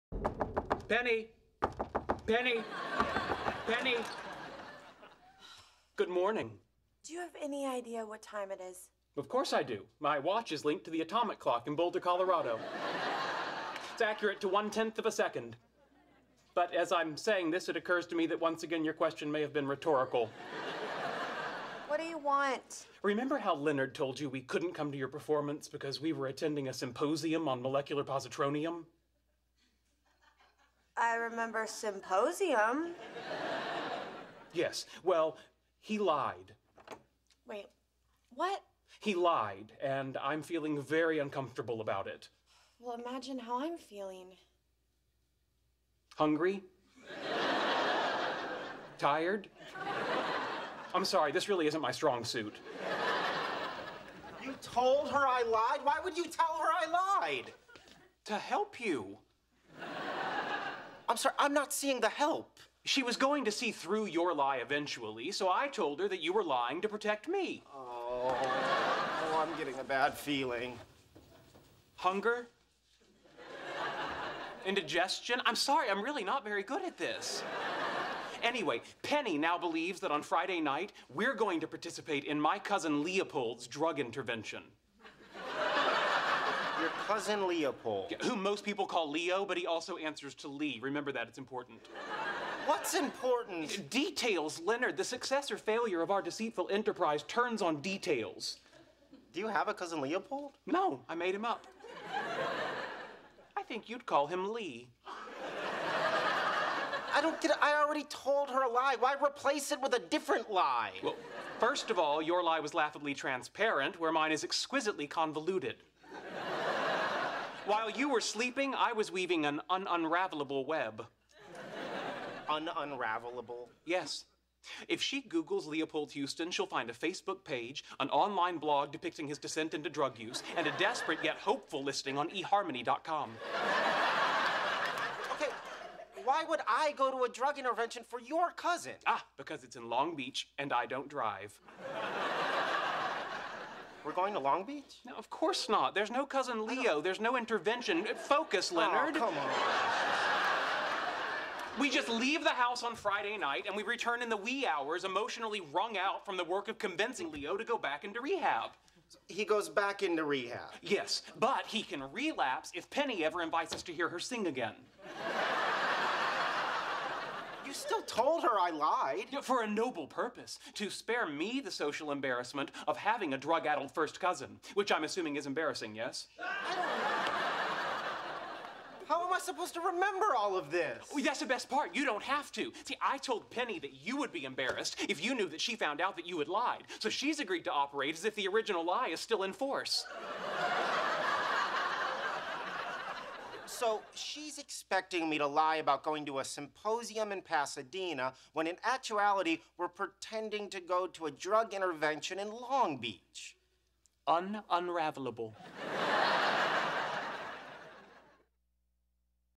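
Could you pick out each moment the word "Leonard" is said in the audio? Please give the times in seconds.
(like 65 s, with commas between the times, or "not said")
23 s, 94 s, 148 s.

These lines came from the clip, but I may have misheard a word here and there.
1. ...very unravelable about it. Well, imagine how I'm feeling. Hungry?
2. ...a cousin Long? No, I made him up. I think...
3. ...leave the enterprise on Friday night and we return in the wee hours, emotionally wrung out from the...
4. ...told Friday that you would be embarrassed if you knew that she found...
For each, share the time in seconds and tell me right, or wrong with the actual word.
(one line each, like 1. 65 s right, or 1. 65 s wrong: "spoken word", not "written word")
1. 40 s wrong: "uncomfortable", not "unravelable"
2. 99 s wrong: "Leopold", not "Long"
3. 152 s wrong: "house", not "enterprise"
4. 183 s wrong: "Penny", not "Friday".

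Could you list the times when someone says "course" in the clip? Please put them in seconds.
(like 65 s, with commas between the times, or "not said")
9 s, 145 s.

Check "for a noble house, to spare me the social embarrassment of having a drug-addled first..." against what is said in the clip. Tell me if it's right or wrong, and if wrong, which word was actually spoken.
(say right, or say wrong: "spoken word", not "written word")
wrong: "purpose", not "house".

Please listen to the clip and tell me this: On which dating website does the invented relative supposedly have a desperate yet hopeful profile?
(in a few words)
eharmony.com.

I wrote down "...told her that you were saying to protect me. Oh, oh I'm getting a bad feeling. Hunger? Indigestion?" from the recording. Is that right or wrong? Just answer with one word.
wrong.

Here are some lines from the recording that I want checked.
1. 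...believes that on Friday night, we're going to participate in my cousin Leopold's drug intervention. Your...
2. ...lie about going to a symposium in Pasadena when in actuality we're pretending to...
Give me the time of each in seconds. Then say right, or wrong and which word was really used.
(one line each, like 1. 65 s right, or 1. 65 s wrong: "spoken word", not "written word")
1. 79 s right
2. 195 s right.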